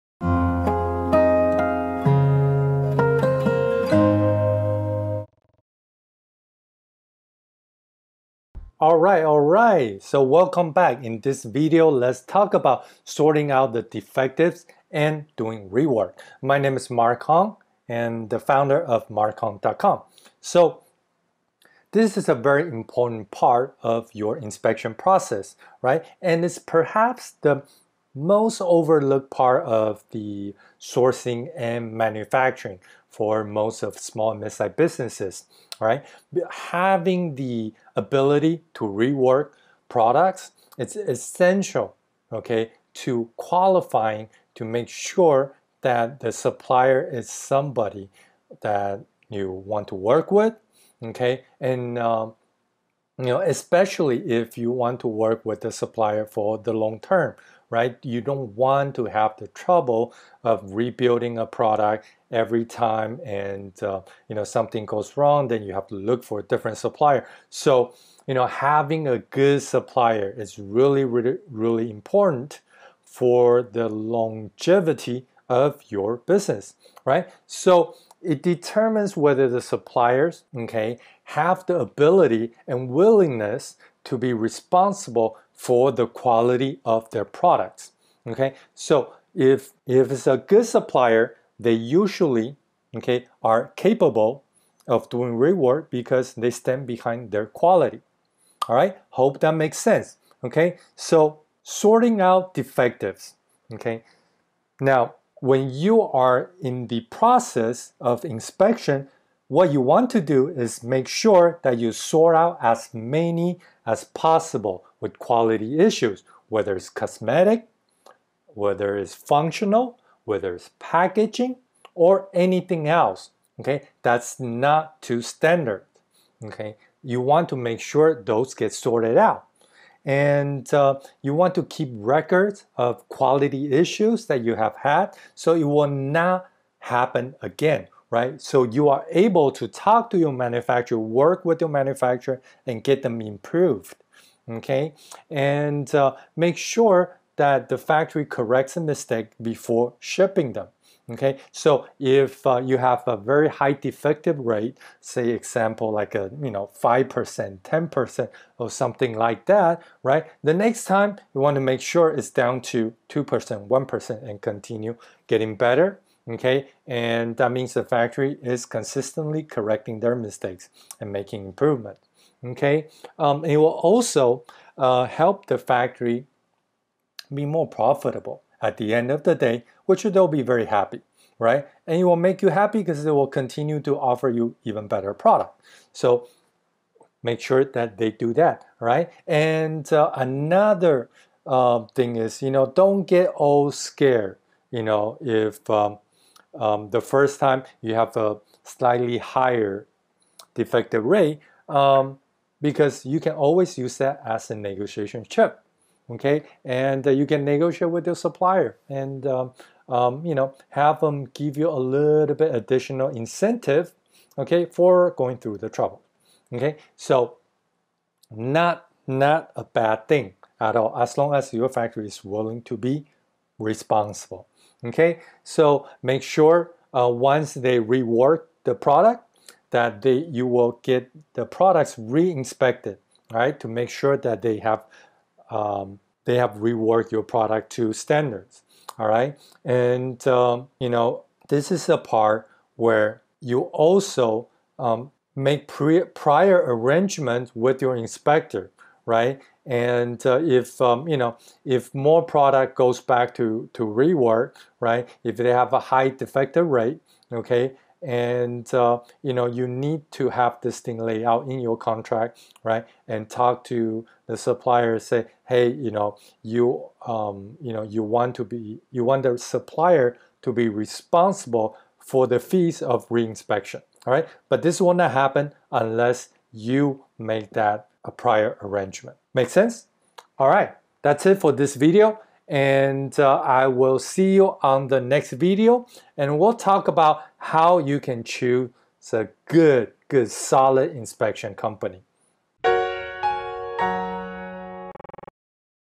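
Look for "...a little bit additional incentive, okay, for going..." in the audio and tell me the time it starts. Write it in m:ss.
3:31.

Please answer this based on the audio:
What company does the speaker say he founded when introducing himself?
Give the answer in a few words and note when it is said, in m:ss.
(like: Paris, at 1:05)
markhong.com, at 0:19.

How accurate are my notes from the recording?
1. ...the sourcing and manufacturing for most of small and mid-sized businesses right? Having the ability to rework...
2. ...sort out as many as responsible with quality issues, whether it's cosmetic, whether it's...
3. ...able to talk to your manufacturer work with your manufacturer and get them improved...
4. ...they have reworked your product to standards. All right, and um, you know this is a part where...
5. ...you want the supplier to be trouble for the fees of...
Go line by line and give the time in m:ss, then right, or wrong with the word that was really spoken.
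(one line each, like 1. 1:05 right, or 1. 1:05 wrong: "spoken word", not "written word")
1. 0:30 right
2. 1:51 wrong: "possible", not "responsible"
3. 2:19 right
4. 3:56 right
5. 4:28 wrong: "responsible", not "trouble".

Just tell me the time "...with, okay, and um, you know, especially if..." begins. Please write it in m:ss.
0:50.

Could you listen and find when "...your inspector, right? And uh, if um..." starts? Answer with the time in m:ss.
4:07.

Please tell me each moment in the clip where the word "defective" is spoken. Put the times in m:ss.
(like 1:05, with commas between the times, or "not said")
0:13, 1:42, 2:33, 3:20, 4:16.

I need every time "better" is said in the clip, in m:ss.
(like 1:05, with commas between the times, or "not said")
2:45, 3:04.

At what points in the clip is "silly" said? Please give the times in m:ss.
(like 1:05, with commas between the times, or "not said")
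not said.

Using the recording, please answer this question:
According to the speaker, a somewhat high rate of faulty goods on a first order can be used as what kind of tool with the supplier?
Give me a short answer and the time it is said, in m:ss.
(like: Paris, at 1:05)
A negotiation chip, at 3:24.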